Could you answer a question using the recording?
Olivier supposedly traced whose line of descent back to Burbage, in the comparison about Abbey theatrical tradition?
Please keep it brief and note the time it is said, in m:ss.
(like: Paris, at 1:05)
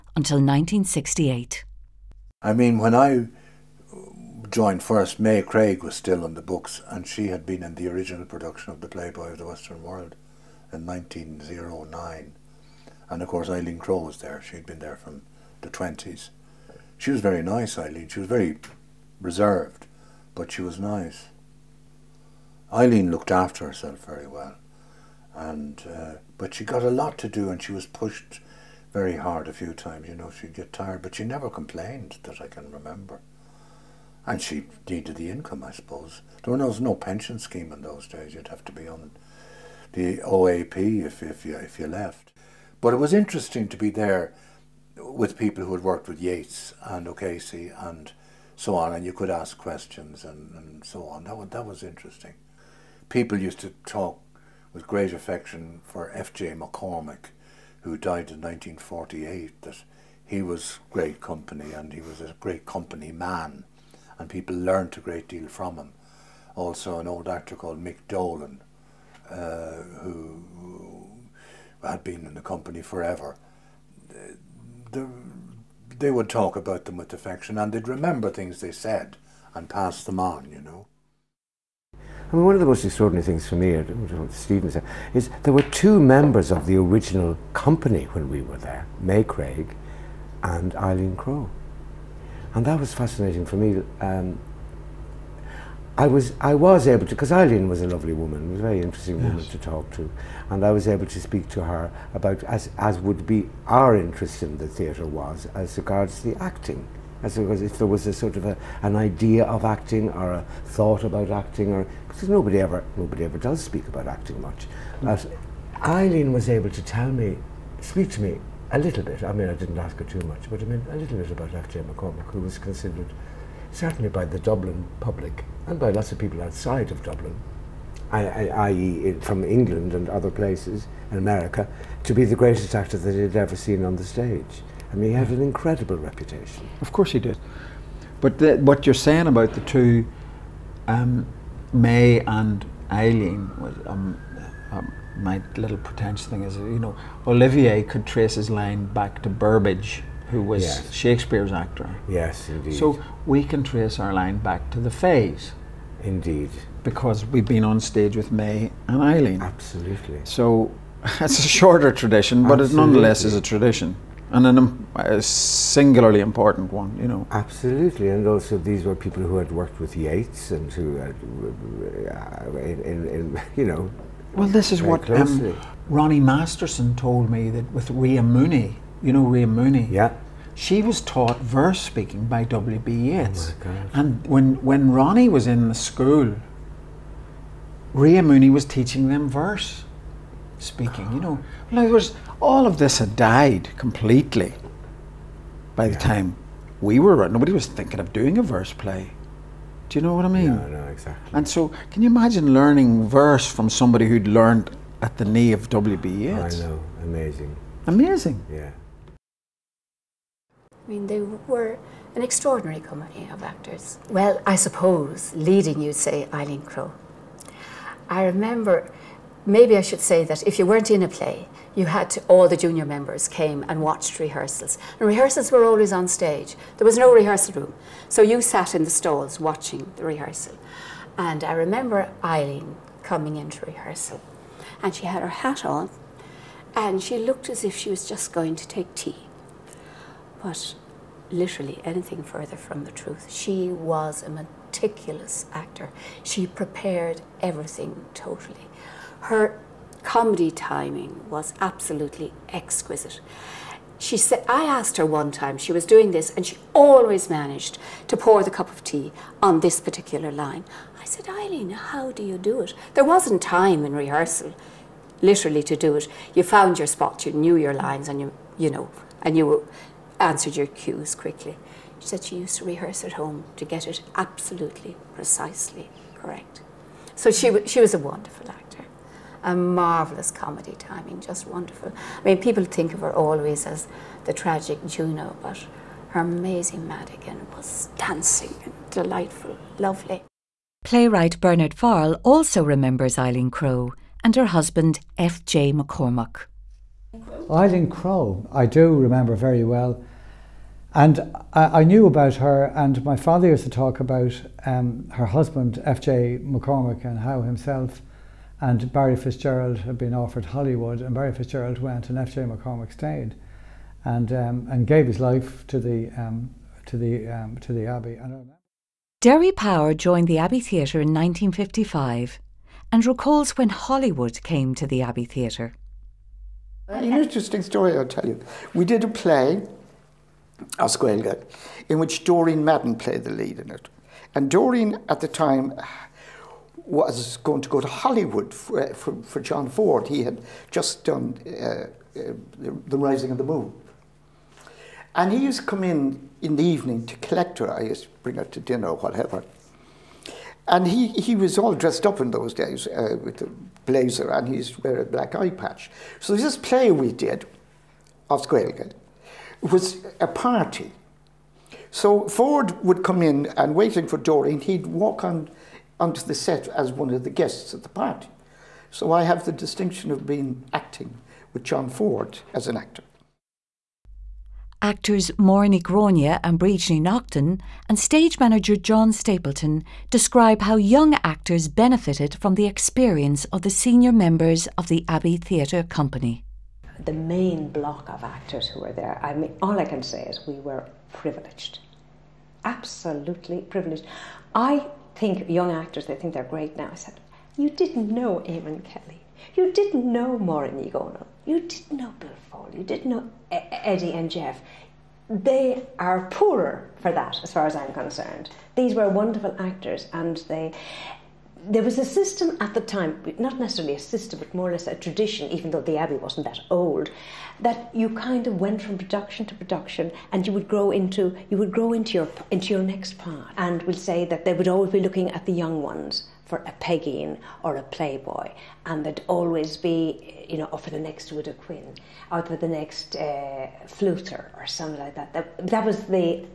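Shakespeare, at 2:30.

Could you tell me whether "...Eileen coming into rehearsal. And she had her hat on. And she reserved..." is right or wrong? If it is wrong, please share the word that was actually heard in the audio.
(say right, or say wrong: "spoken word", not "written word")
wrong: "looked", not "reserved".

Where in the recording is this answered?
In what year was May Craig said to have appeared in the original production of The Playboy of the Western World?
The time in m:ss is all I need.
0:10.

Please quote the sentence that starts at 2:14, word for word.
I mean, he had an incredible reputation.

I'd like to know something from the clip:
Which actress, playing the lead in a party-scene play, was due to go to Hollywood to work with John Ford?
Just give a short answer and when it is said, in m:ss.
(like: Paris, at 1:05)
Doreen Madden, at 5:32.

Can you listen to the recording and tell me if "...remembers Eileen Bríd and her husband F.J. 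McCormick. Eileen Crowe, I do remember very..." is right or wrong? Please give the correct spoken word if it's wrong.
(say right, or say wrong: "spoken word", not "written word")
wrong: "Crowe", not "Bríd".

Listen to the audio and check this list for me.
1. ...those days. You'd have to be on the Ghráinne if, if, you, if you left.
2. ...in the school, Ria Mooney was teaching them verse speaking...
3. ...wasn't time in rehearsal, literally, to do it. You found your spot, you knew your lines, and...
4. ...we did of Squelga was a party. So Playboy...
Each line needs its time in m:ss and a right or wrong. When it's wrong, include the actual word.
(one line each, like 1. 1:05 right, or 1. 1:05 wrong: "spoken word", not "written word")
1. 0:37 wrong: "OAP", not "Ghráinne"
2. 3:05 right
3. 4:23 right
4. 5:56 wrong: "Ford", not "Playboy".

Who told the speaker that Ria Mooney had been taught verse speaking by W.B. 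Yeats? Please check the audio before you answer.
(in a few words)
Ronnie Masterson.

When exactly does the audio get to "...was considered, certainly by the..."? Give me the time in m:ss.
2:02.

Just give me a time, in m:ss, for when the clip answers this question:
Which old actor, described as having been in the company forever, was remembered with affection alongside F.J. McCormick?
1:07.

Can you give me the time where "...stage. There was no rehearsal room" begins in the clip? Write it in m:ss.
3:46.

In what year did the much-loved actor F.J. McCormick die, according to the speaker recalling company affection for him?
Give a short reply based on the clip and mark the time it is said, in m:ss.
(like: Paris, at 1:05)
1948, at 0:58.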